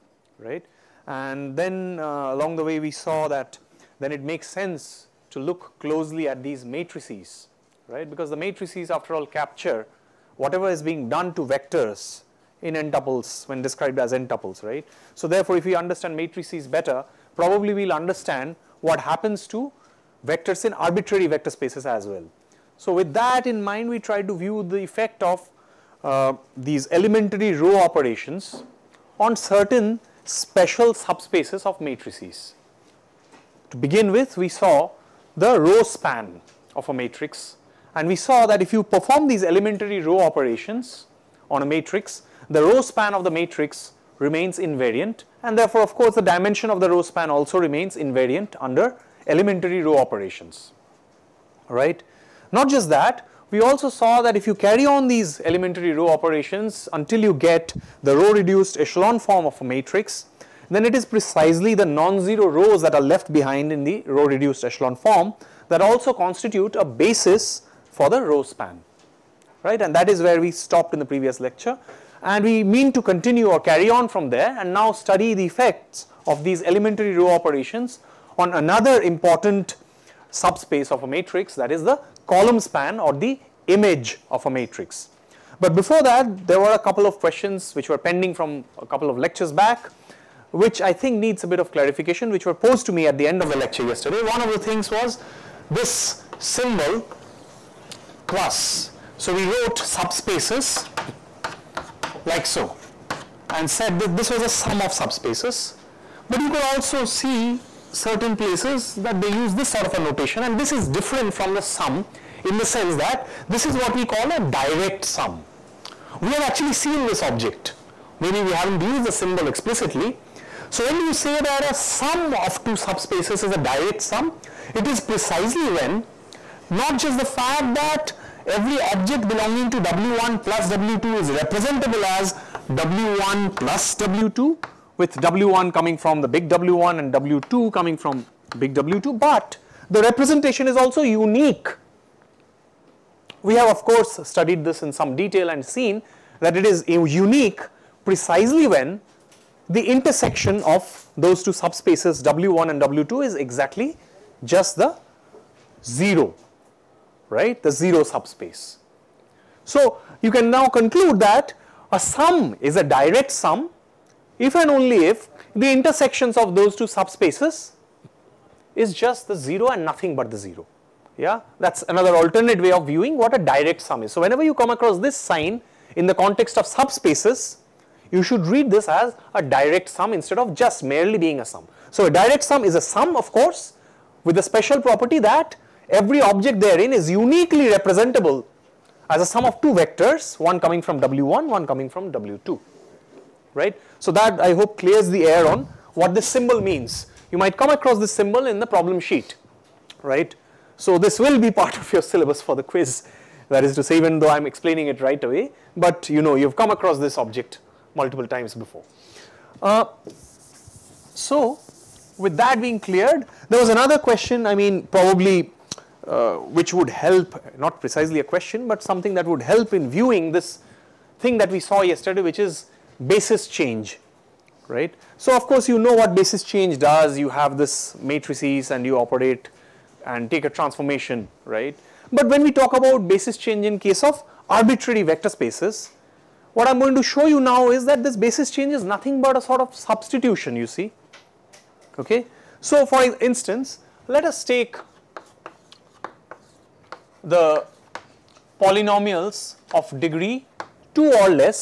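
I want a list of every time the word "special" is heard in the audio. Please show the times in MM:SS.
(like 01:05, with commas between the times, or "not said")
00:30, 03:04.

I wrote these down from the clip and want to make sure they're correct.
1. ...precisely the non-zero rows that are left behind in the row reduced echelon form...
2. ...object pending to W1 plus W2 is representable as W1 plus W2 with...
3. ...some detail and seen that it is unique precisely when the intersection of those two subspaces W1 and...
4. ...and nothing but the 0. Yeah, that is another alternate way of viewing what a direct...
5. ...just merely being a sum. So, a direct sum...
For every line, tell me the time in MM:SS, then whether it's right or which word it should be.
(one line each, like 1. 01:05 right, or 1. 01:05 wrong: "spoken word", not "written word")
1. 01:01 right
2. 02:08 wrong: "belonging", not "pending"
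3. 02:24 right
4. 02:49 right
5. 03:00 right.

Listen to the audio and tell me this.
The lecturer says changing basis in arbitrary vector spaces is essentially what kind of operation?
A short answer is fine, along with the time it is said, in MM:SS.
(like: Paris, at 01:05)
substitution, at 03:59.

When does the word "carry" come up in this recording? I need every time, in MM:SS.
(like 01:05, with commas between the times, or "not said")
00:54, 01:13.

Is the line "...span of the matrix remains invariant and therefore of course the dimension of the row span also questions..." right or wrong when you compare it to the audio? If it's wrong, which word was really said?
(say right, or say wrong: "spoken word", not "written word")
wrong: "remains", not "questions".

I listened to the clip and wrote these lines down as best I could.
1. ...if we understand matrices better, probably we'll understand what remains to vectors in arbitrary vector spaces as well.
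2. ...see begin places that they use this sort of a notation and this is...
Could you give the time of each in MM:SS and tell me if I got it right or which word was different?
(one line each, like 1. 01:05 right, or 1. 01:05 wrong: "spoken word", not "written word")
1. 00:15 wrong: "happens", not "remains"
2. 01:47 wrong: "certain", not "begin".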